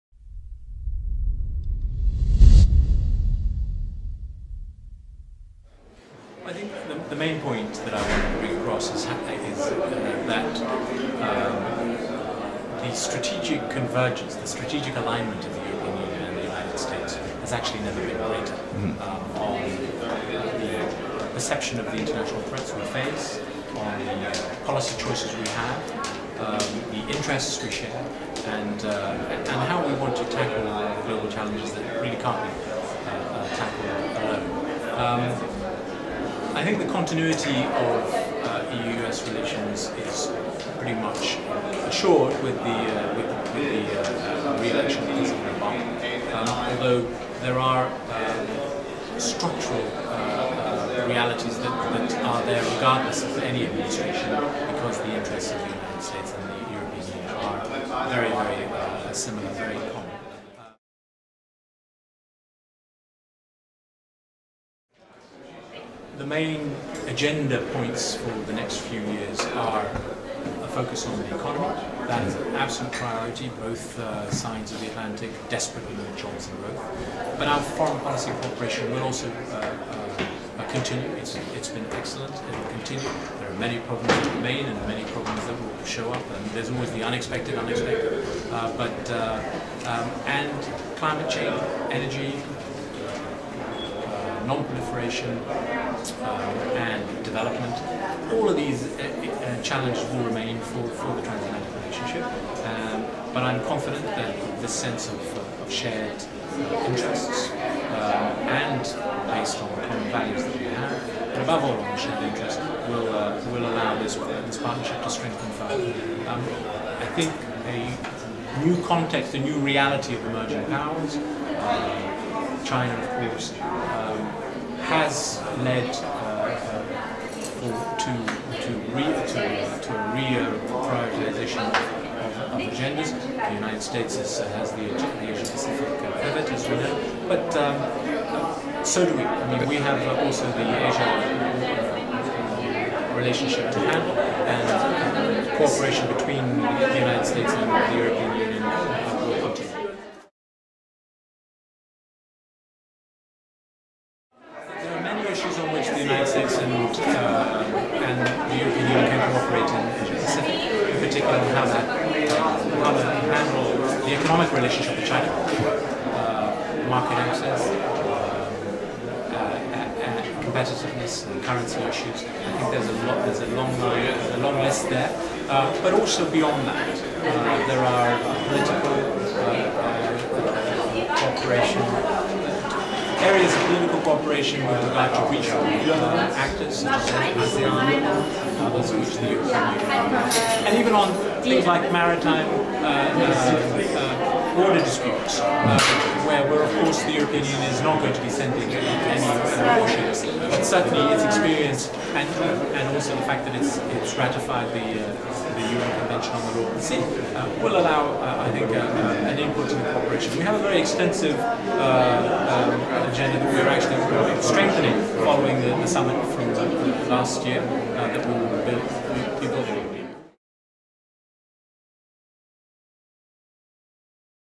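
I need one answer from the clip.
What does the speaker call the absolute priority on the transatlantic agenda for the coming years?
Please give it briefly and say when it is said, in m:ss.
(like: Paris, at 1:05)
the economy, at 1:11.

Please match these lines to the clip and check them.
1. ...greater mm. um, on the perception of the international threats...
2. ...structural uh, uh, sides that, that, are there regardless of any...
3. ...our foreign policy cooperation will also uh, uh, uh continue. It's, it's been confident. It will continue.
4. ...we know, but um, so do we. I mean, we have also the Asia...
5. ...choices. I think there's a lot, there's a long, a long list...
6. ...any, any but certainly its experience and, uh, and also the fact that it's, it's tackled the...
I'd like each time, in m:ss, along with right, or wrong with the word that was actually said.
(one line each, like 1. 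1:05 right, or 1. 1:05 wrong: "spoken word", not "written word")
1. 0:18 right
2. 0:49 wrong: "realities", not "sides"
3. 1:17 wrong: "excellent", not "confident"
4. 2:16 right
5. 2:51 wrong: "issues", not "choices"
6. 3:18 wrong: "ratified", not "tackled".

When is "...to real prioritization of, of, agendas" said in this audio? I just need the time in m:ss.
2:09.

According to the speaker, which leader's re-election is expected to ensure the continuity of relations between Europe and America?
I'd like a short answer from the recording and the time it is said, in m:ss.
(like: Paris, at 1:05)
President Obama, at 0:45.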